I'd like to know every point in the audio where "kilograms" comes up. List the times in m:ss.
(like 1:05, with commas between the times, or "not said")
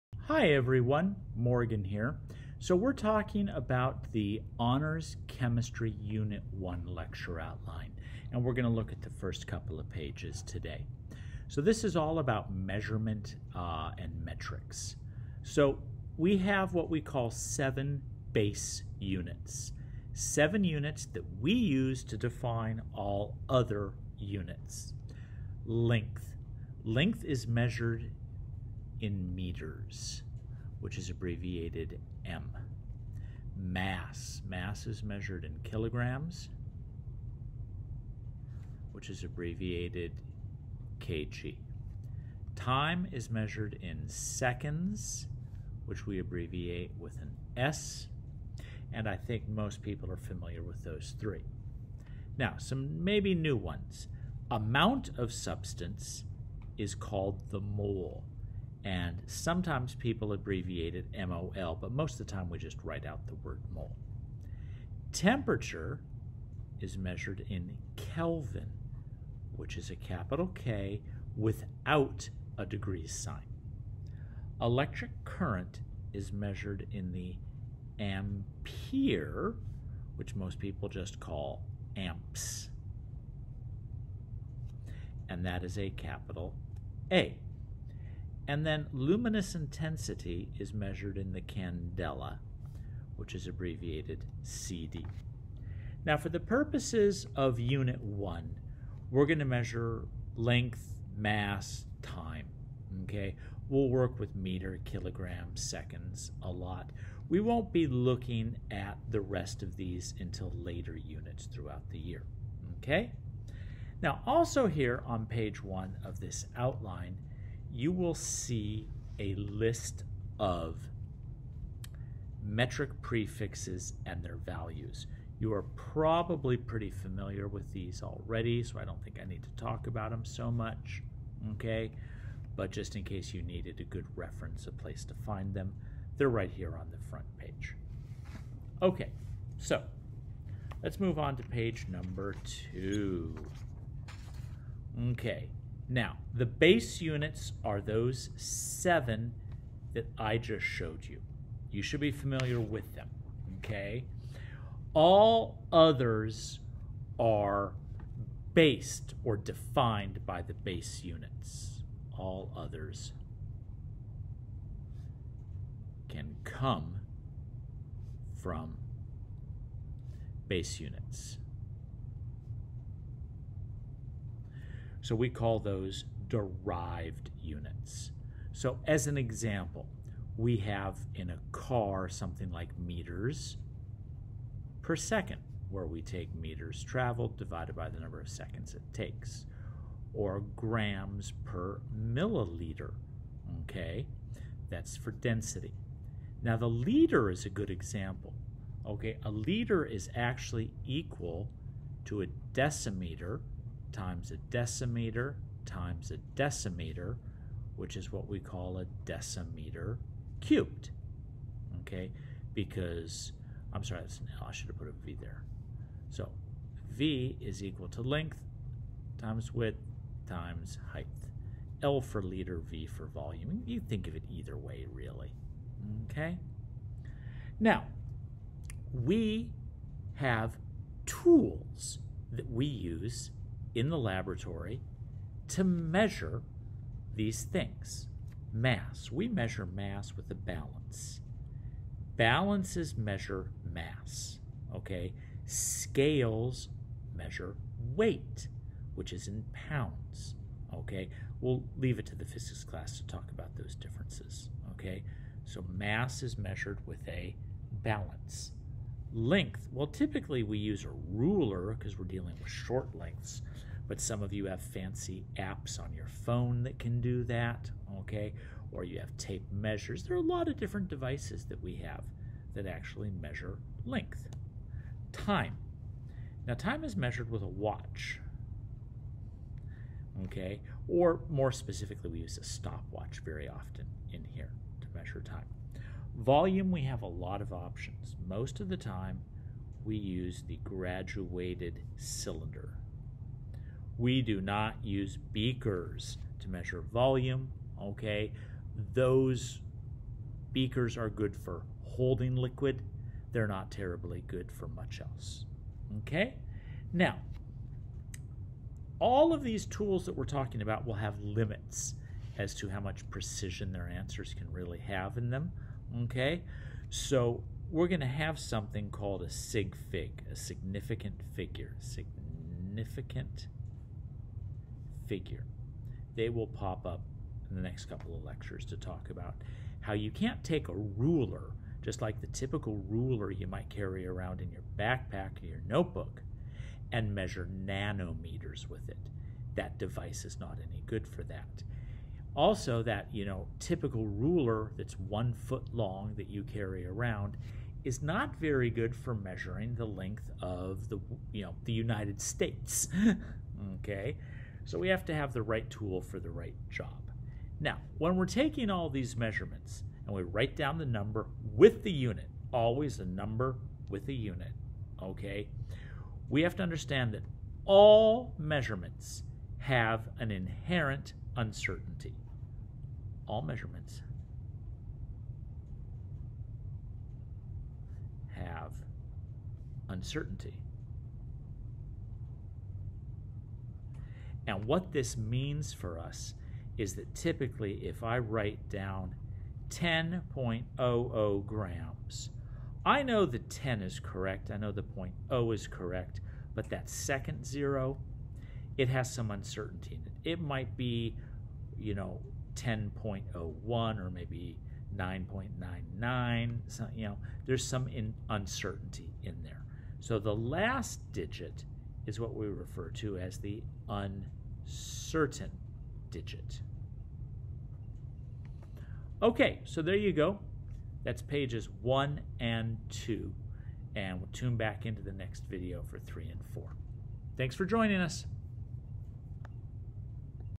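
0:35, 1:44.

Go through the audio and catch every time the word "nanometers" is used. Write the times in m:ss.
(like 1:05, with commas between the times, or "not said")
5:37.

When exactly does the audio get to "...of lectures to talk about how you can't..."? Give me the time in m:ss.
5:28.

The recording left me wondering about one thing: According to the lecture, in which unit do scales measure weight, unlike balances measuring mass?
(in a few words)
pounds.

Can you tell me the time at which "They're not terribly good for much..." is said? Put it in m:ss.
5:03.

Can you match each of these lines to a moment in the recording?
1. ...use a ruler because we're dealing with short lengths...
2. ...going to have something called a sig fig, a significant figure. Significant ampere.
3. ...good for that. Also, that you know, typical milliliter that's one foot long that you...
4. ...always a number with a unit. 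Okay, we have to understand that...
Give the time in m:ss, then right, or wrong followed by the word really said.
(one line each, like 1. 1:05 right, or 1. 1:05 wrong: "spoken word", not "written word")
1. 4:20 right
2. 5:17 wrong: "figure", not "ampere"
3. 5:40 wrong: "ruler", not "milliliter"
4. 6:02 right.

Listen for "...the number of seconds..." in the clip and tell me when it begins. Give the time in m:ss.
3:07.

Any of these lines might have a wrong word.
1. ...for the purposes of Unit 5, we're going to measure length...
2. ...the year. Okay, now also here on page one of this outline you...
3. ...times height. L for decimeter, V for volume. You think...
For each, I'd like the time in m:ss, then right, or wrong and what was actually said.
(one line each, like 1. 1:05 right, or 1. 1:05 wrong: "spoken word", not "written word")
1. 1:36 wrong: "1", not "5"
2. 1:51 right
3. 3:40 wrong: "liter", not "decimeter".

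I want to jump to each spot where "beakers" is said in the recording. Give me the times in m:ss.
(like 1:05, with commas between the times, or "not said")
4:55, 5:00.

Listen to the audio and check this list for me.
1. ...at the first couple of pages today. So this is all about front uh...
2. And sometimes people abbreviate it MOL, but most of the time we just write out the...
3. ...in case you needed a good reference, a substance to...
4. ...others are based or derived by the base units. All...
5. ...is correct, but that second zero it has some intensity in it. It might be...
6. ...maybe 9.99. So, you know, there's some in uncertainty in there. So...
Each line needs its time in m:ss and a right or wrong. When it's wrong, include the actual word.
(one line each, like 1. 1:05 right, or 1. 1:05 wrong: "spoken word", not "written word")
1. 0:08 wrong: "measurement", not "front"
2. 0:58 right
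3. 2:12 wrong: "place", not "substance"
4. 2:35 wrong: "defined", not "derived"
5. 6:35 wrong: "uncertainty", not "intensity"
6. 6:44 right.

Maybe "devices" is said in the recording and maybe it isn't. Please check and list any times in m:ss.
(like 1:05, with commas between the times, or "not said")
4:30, 5:39.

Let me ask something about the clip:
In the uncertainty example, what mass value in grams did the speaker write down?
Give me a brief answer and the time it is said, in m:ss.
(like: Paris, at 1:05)
10.00 grams, at 6:29.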